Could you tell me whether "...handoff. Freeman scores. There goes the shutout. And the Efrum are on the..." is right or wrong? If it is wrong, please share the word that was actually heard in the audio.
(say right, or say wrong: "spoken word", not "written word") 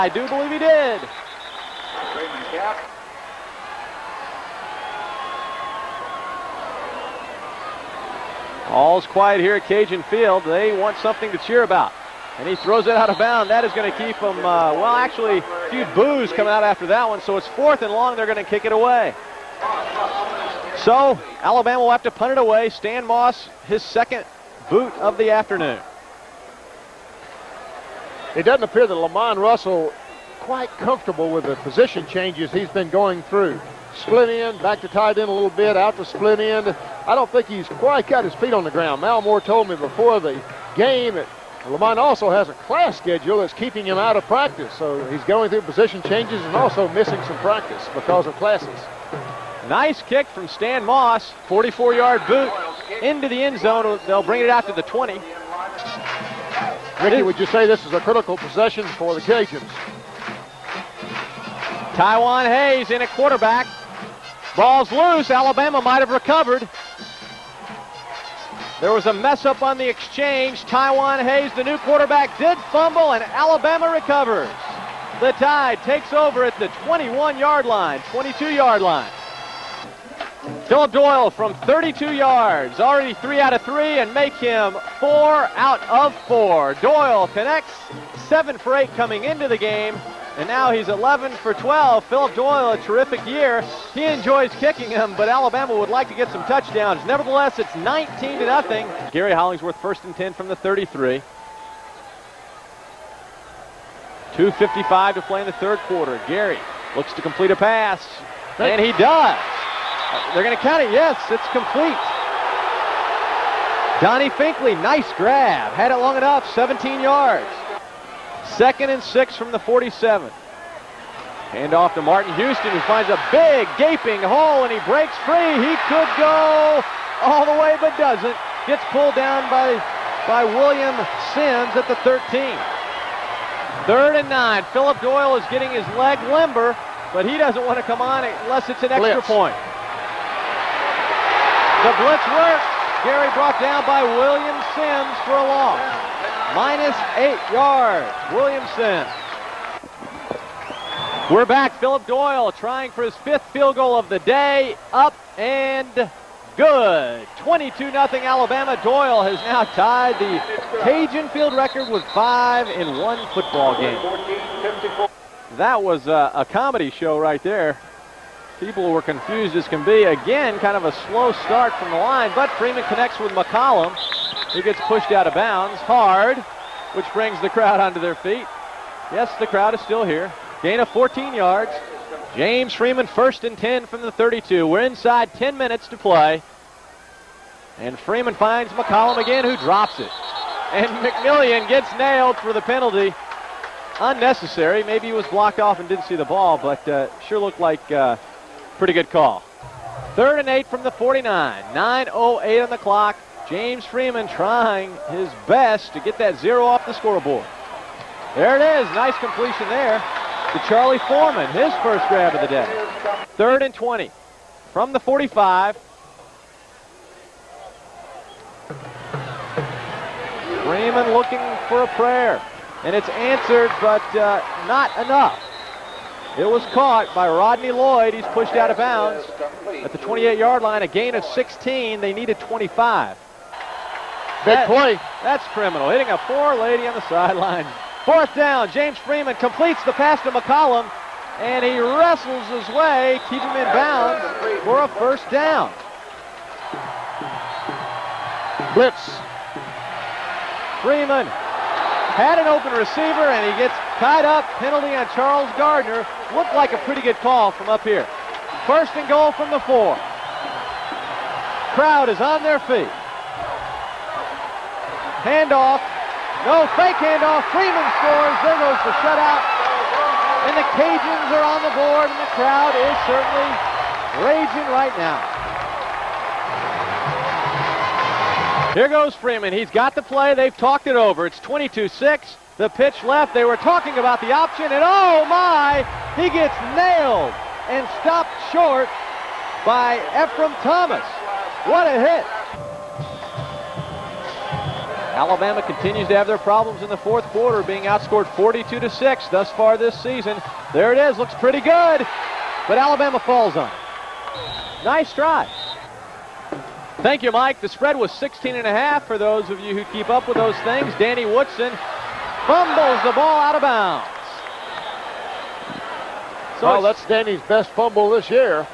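wrong: "Cajuns", not "Efrum".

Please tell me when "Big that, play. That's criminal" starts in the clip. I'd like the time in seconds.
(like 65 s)
234 s.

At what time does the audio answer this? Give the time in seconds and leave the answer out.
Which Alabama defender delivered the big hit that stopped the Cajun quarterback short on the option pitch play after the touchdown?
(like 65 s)
290 s.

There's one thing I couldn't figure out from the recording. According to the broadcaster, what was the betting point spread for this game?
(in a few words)
16 and a half.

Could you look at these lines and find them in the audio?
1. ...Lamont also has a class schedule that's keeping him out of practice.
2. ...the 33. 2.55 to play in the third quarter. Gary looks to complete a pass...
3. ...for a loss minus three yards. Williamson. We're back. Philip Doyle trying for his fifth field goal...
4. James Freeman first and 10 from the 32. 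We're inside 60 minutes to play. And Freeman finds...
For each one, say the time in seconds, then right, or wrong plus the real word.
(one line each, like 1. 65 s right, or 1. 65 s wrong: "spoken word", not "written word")
1. 41 s right
2. 100 s right
3. 145 s wrong: "eight", not "three"
4. 182 s wrong: "10", not "60".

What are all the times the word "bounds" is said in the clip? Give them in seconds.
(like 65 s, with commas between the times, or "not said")
13 s, 175 s, 228 s, 243 s, 313 s.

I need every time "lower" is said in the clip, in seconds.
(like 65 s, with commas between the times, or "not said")
not said.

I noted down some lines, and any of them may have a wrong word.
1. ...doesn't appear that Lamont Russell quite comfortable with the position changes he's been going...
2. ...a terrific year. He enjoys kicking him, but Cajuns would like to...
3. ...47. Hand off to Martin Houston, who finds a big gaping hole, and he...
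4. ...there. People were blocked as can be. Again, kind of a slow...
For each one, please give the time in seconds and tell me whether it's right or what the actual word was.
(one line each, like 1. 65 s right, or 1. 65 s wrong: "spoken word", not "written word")
1. 28 s right
2. 92 s wrong: "Alabama", not "Cajuns"
3. 119 s right
4. 167 s wrong: "confused", not "blocked".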